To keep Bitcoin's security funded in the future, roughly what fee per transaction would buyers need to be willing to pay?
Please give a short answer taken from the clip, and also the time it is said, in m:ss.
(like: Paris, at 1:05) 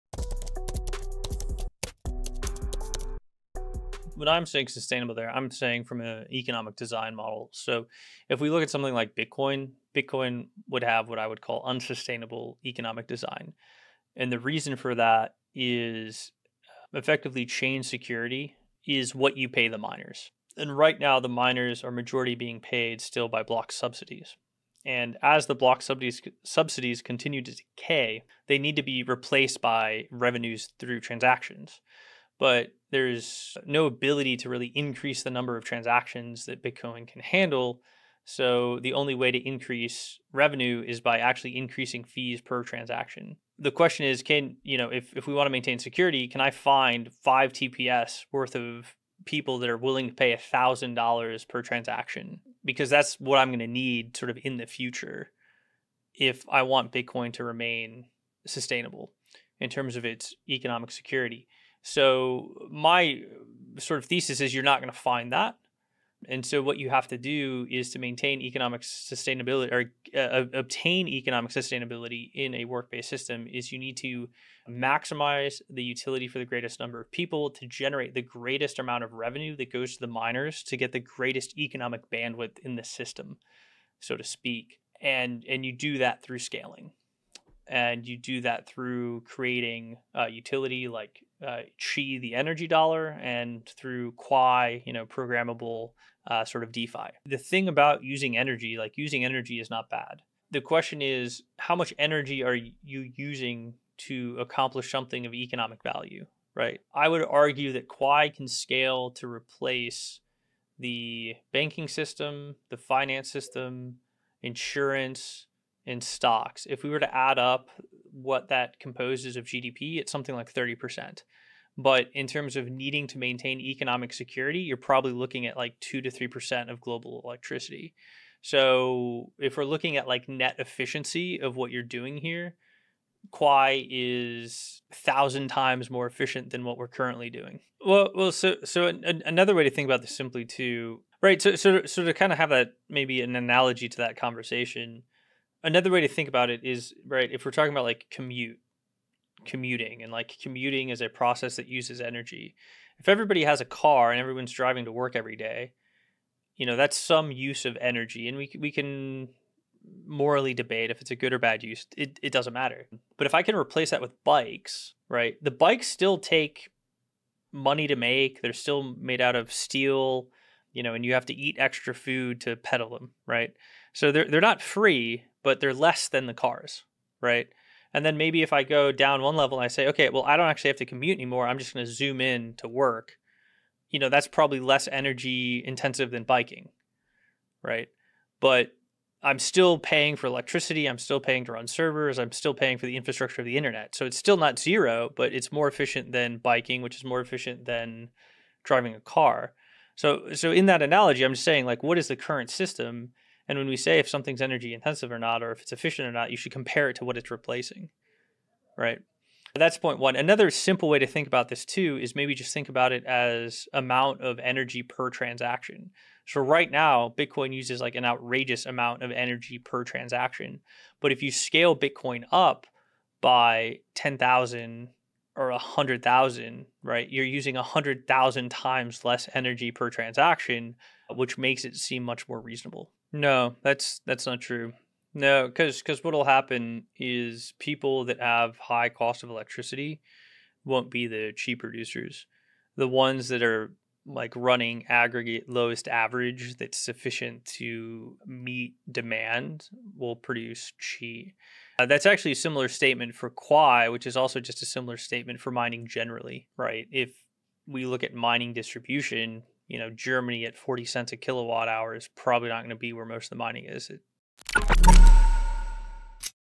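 $1,000, at 0:50.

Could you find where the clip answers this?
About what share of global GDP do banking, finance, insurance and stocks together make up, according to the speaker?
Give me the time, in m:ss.
2:00.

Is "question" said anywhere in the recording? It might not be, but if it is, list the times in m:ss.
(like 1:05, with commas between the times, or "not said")
0:43, 1:40.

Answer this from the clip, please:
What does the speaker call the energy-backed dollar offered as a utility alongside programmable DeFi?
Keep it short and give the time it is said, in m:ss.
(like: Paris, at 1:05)
Qi, at 1:31.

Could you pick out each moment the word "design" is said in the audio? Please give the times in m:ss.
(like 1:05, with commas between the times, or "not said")
0:06, 0:13.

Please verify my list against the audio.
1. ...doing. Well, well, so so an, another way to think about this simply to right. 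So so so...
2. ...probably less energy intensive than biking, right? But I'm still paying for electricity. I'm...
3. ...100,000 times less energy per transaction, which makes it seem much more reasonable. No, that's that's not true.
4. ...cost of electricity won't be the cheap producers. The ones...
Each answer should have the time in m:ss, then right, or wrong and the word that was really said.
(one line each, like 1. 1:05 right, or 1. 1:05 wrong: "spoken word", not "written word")
1. 2:17 right
2. 3:04 right
3. 3:47 right
4. 3:58 right.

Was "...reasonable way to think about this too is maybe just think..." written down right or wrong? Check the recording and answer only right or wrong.
wrong.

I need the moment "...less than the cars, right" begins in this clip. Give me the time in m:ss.
2:55.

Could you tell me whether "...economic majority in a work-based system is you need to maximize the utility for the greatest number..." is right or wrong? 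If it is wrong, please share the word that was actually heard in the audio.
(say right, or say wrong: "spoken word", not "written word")
wrong: "sustainability", not "majority".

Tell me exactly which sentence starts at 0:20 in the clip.
And right now, the miners are majority being paid still by block subsidies.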